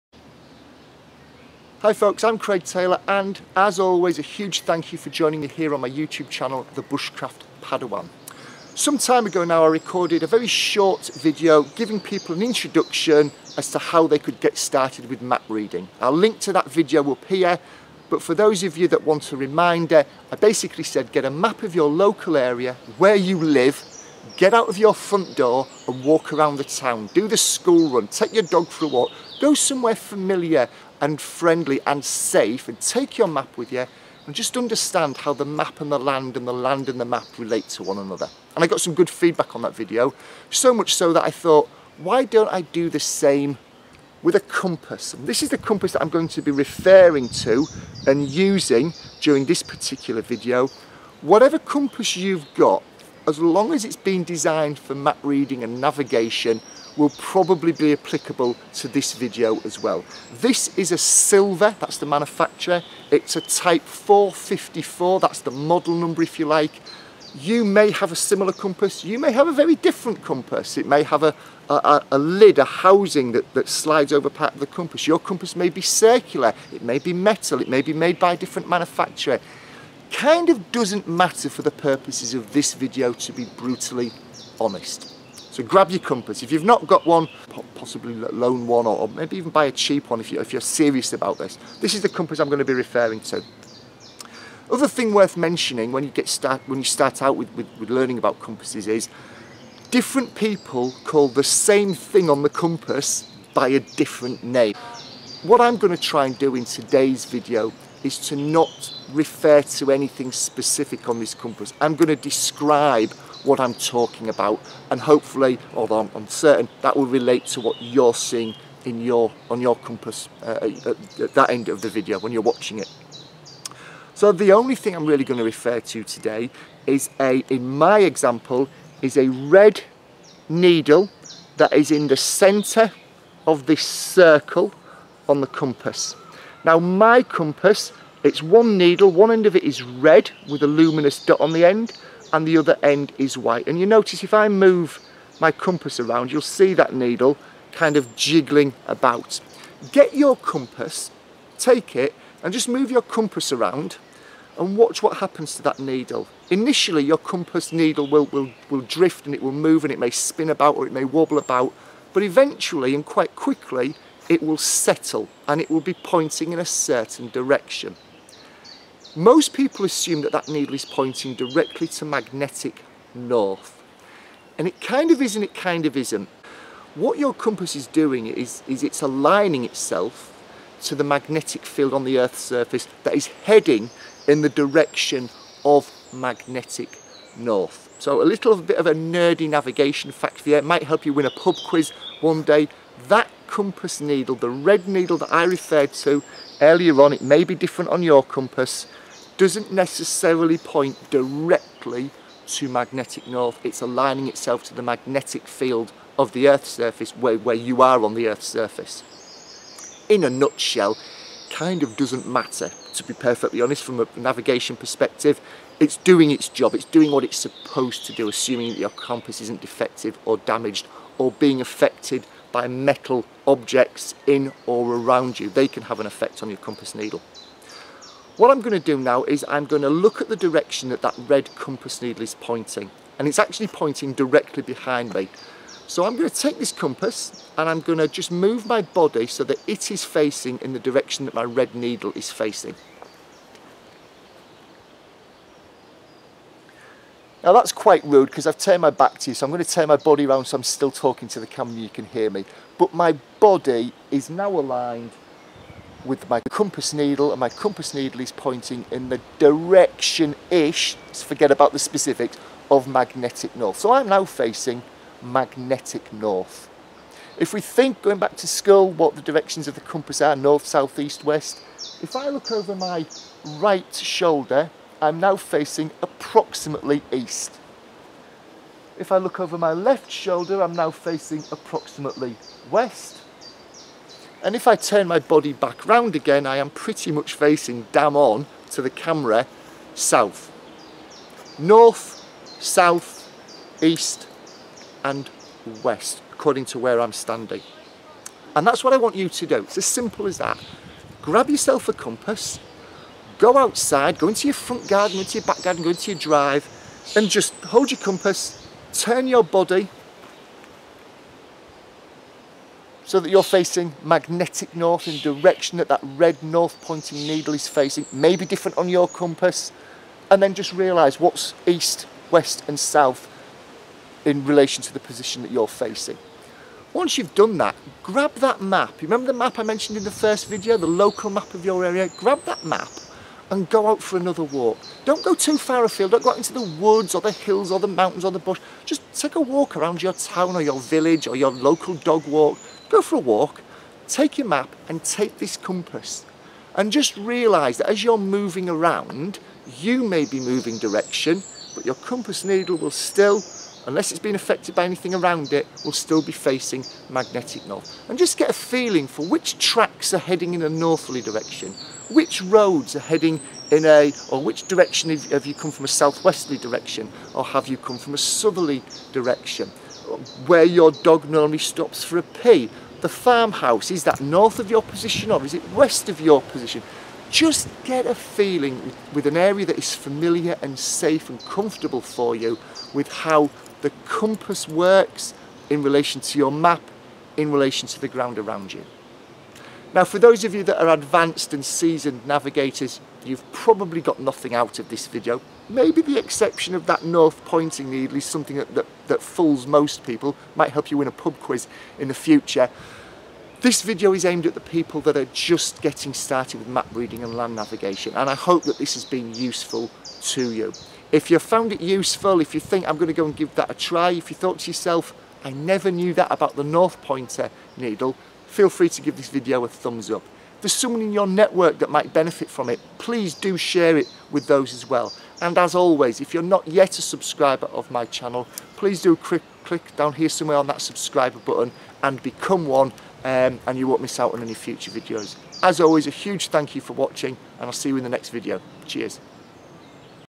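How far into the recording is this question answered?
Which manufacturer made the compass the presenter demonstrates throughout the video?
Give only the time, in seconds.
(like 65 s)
60 s.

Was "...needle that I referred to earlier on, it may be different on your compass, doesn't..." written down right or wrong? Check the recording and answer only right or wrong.
right.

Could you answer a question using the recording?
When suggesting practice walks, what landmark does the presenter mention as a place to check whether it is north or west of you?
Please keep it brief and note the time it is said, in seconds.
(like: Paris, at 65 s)
The farmhouse, at 373 s.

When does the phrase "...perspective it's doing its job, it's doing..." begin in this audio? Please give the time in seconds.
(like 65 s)
214 s.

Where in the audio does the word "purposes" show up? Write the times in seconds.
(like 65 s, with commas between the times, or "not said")
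81 s.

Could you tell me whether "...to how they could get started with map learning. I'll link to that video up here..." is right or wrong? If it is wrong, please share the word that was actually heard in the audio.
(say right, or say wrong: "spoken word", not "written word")
wrong: "reading", not "learning".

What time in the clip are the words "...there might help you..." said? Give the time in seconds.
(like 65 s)
190 s.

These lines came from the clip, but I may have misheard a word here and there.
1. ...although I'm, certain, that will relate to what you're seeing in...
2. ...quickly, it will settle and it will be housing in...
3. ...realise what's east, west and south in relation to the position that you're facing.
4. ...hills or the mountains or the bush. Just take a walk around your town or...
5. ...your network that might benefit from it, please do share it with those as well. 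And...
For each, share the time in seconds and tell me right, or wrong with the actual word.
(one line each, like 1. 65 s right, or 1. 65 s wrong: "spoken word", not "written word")
1. 115 s right
2. 163 s wrong: "pointing", not "housing"
3. 320 s right
4. 337 s right
5. 421 s right.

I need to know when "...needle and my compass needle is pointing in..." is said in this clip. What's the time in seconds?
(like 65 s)
256 s.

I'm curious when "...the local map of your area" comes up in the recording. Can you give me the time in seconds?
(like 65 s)
330 s.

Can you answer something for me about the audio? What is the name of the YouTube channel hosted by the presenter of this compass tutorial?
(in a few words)
The Bushcraft Padawan.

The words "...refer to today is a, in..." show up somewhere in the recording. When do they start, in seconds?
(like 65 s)
125 s.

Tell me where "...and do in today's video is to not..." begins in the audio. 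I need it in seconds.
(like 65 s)
106 s.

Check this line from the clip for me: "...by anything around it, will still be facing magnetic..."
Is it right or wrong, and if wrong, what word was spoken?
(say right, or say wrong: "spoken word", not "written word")
right.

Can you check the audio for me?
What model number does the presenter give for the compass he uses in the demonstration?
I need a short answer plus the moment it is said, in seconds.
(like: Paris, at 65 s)
454, at 63 s.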